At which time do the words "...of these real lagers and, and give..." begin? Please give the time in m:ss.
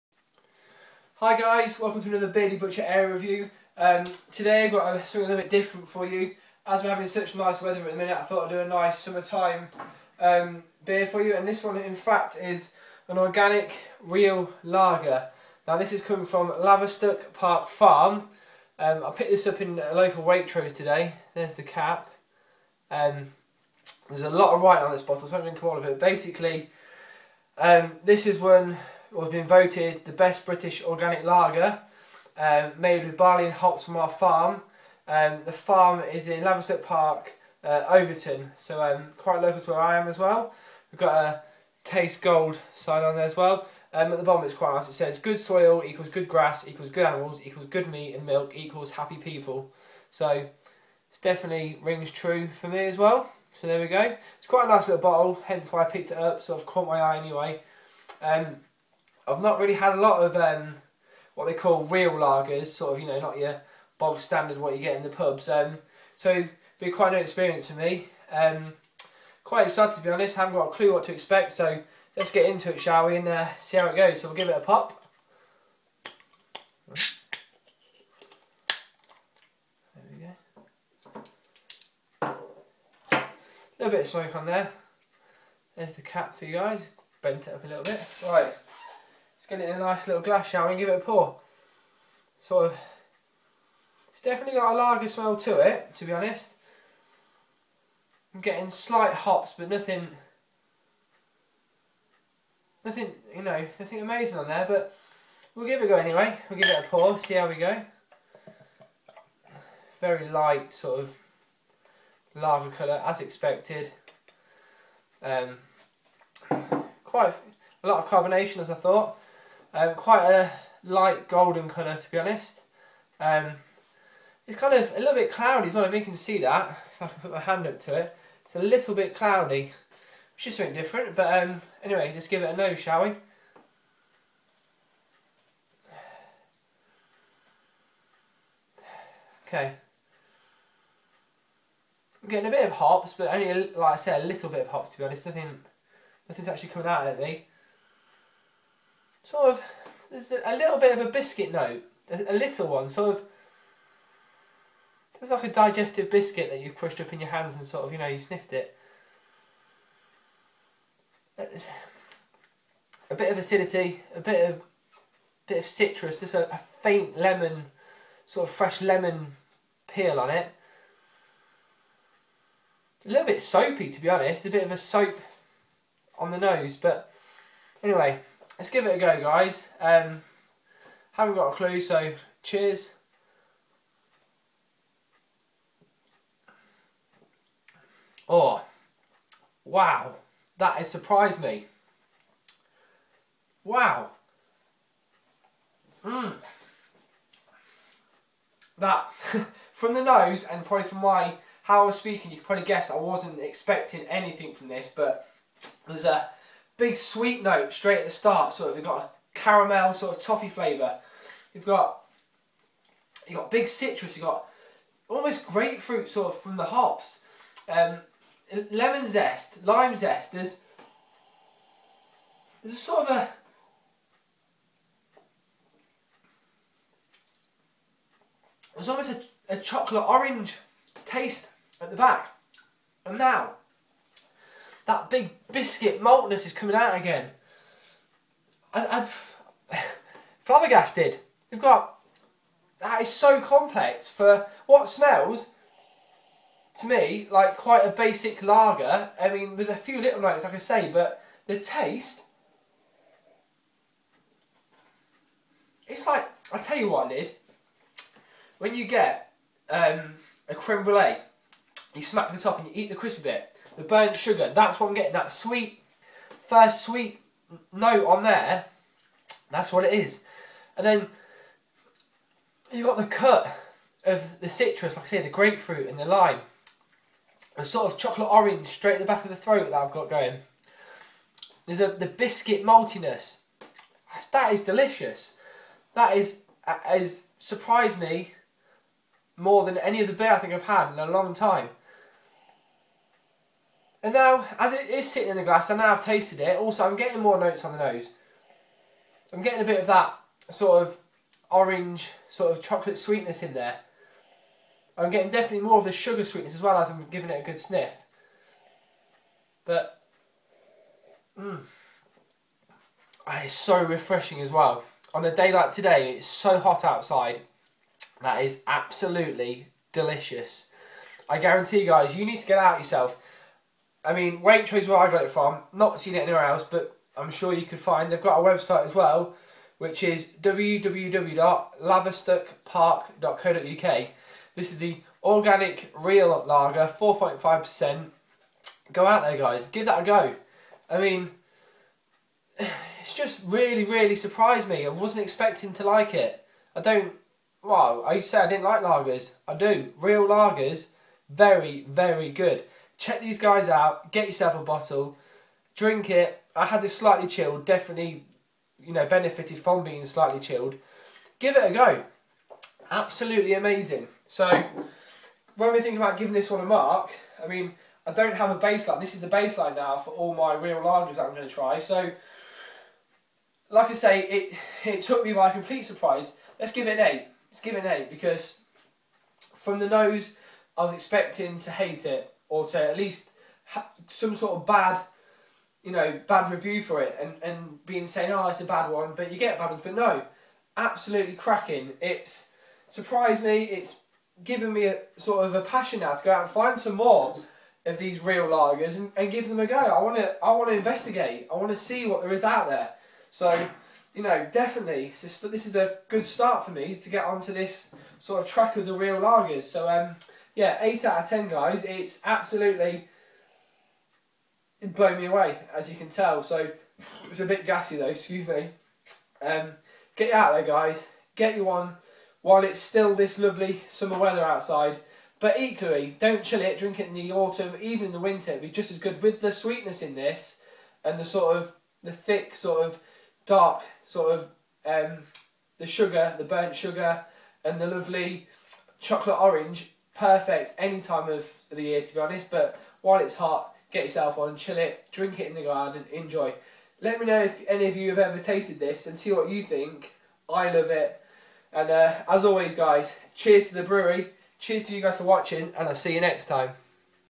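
6:37.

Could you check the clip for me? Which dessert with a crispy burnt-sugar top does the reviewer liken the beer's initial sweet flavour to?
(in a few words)
Creme brulee.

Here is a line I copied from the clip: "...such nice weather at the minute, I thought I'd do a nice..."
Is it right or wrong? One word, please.
right.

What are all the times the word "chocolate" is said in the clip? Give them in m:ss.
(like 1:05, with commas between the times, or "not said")
3:49, 4:37, 5:02, 7:18.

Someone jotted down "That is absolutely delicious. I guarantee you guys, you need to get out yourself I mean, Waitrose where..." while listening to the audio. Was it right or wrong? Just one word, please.
right.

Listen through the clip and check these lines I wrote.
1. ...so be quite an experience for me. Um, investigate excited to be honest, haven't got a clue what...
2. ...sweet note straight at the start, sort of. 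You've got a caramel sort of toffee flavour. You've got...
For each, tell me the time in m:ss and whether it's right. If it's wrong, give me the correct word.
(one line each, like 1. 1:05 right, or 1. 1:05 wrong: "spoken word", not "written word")
1. 1:06 wrong: "quite", not "investigate"
2. 3:26 right.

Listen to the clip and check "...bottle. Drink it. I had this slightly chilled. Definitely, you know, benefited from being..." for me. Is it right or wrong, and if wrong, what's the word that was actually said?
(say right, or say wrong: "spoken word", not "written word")
right.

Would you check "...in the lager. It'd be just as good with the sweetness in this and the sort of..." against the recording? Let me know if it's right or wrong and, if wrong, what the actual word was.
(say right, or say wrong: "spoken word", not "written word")
wrong: "winter", not "lager".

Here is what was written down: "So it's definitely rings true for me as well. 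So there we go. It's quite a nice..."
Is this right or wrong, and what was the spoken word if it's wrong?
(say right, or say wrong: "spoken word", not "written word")
right.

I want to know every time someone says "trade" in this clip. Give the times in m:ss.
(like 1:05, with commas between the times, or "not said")
not said.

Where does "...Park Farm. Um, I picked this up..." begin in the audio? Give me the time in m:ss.
0:17.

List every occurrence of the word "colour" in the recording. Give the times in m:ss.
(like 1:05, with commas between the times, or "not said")
1:52, 2:01.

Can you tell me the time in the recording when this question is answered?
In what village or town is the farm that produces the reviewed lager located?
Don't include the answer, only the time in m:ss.
0:37.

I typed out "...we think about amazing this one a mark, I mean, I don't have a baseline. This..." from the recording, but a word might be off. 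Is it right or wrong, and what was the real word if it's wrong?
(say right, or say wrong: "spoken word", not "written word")
wrong: "giving", not "amazing".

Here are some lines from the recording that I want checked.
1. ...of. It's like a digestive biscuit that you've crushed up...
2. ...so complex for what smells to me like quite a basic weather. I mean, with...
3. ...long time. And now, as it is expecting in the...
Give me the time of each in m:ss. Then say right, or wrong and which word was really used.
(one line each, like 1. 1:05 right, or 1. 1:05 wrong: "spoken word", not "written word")
1. 2:33 right
2. 4:03 wrong: "lager", not "weather"
3. 4:51 wrong: "sitting", not "expecting".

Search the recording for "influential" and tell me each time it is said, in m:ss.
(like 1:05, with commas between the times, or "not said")
not said.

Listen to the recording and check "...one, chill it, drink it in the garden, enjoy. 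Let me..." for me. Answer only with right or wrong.
right.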